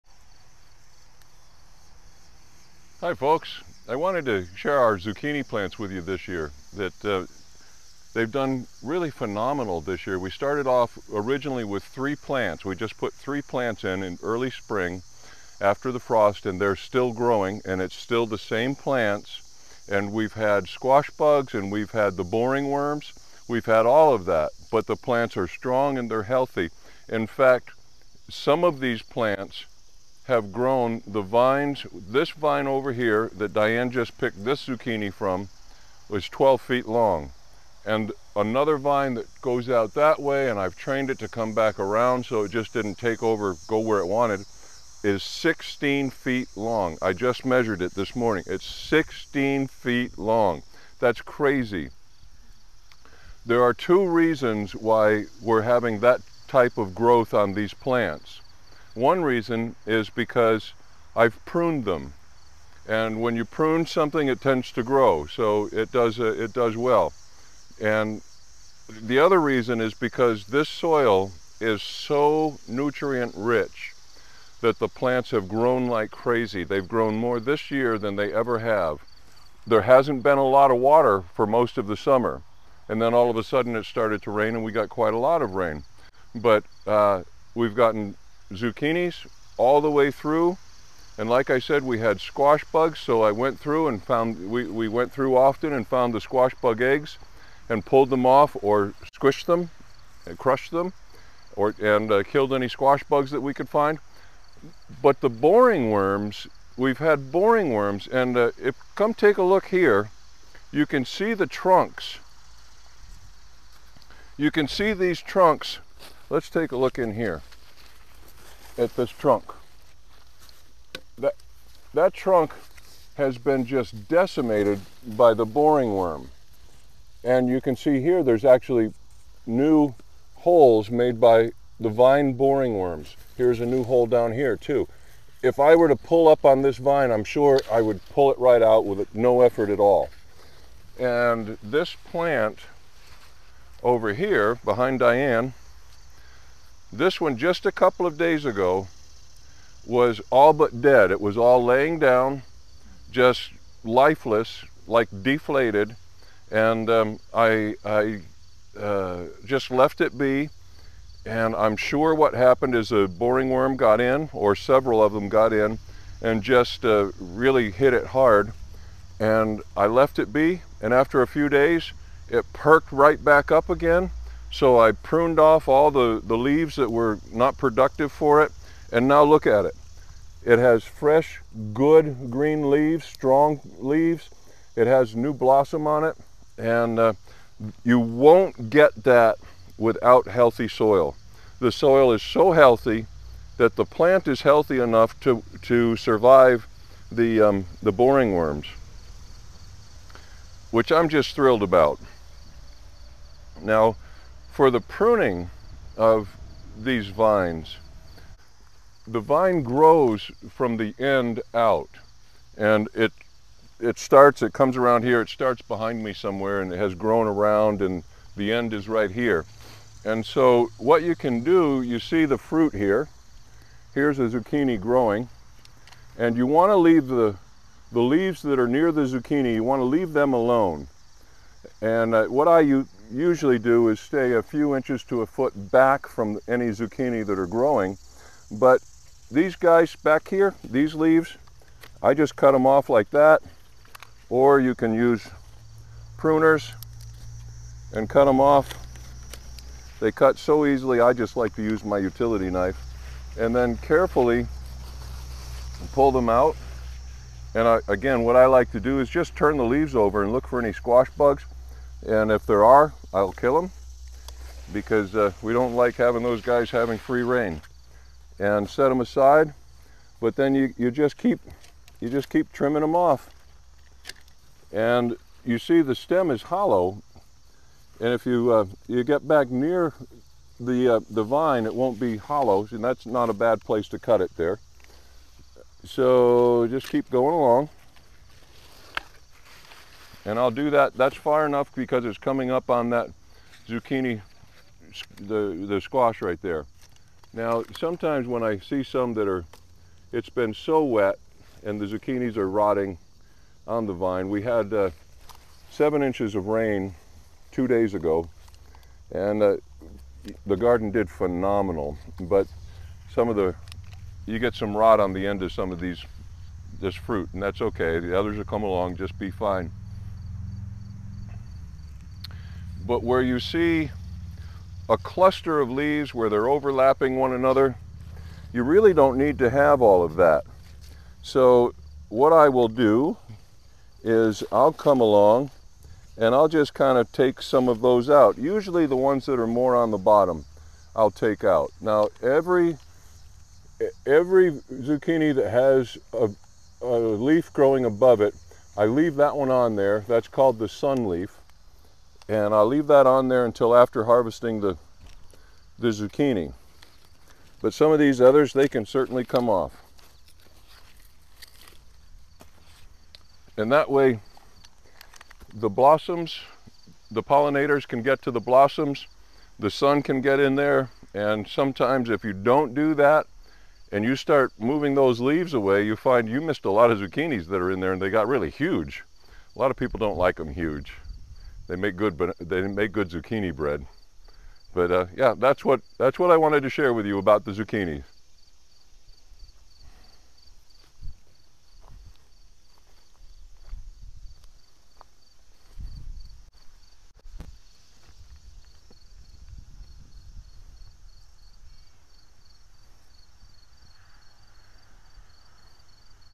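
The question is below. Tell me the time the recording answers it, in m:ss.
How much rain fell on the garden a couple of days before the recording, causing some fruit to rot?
5:05.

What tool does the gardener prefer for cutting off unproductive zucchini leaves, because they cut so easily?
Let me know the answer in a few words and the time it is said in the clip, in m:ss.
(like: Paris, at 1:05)
utility knife, at 4:11.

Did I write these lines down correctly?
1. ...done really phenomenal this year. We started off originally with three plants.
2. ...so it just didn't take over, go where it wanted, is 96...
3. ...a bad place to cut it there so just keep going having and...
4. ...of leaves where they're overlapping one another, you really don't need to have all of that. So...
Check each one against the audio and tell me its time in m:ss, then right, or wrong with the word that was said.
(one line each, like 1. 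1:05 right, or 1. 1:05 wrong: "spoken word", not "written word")
1. 0:08 right
2. 0:42 wrong: "16", not "96"
3. 4:43 wrong: "along", not "having"
4. 5:25 right.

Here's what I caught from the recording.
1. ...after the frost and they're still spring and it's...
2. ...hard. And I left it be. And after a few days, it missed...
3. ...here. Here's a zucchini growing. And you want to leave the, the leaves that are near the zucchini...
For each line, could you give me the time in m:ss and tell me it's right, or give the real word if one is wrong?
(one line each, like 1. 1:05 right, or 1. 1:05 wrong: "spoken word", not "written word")
1. 0:15 wrong: "growing", not "spring"
2. 2:48 wrong: "perked", not "missed"
3. 3:42 right.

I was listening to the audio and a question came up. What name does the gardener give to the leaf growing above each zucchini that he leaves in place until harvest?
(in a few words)
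sun leaf.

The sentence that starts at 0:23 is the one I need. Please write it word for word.
We've had all of that, but the plants are strong and they're healthy.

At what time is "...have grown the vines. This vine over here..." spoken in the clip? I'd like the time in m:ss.
0:30.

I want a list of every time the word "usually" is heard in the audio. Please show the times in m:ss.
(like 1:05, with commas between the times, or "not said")
3:53, 5:38.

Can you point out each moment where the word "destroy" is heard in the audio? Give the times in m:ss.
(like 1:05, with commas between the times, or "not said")
not said.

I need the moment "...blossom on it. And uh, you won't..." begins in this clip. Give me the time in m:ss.
3:05.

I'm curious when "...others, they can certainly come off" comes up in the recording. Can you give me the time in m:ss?
5:58.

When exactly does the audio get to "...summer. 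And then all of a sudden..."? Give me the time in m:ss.
1:21.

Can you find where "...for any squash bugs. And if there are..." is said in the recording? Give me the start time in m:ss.
4:20.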